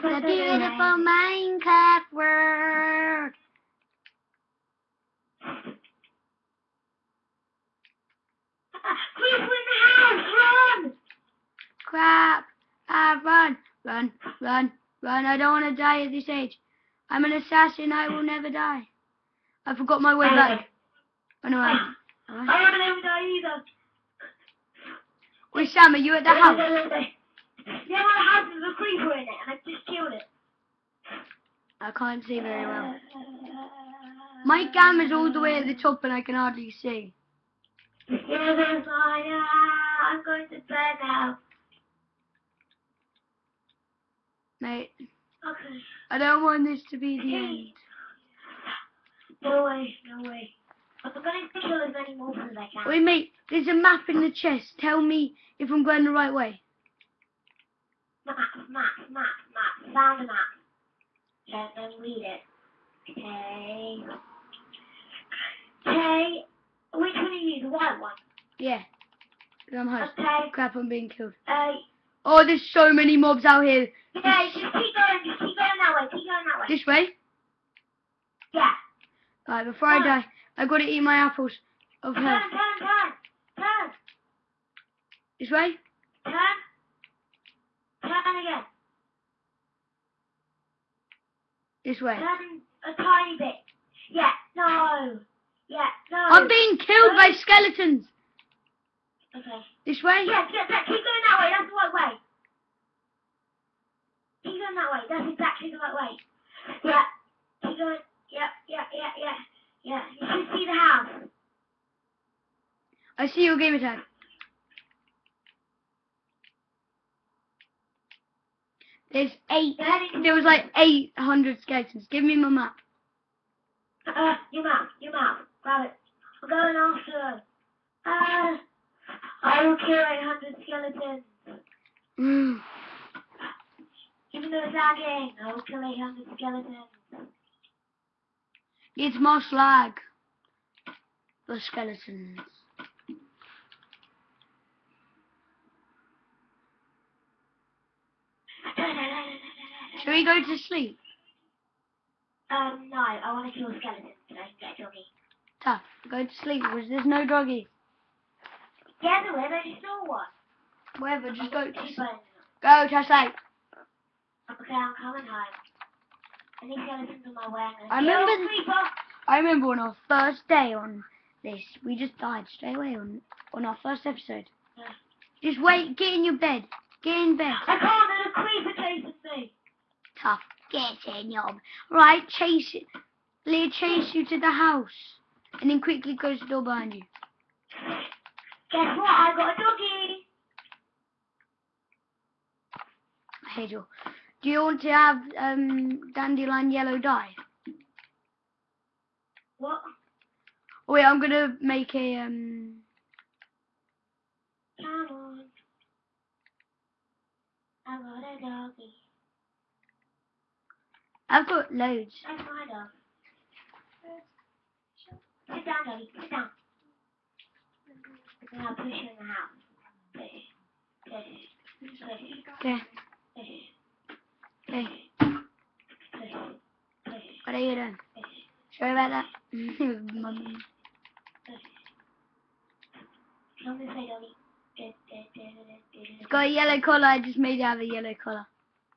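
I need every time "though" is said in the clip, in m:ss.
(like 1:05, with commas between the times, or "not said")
2:14.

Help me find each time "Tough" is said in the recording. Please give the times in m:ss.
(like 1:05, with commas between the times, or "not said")
2:35, 3:00.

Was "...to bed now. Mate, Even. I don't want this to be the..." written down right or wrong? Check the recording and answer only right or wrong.
wrong.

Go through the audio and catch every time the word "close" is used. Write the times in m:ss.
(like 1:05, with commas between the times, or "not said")
3:06.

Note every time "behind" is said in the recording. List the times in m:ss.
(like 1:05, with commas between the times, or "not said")
3:06.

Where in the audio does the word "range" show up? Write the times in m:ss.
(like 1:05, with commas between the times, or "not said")
not said.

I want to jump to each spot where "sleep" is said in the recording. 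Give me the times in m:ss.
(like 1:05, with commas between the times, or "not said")
2:30, 2:36.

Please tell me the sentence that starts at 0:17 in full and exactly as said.
I'm an assassin, I will never die.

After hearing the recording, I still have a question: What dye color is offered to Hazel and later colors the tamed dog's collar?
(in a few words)
dandelion yellow.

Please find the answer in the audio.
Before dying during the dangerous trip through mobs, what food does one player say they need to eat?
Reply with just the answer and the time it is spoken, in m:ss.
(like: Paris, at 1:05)
apples, at 1:21.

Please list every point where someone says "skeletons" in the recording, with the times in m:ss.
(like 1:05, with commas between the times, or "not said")
1:37, 2:01, 2:10, 2:16, 2:21, 2:33.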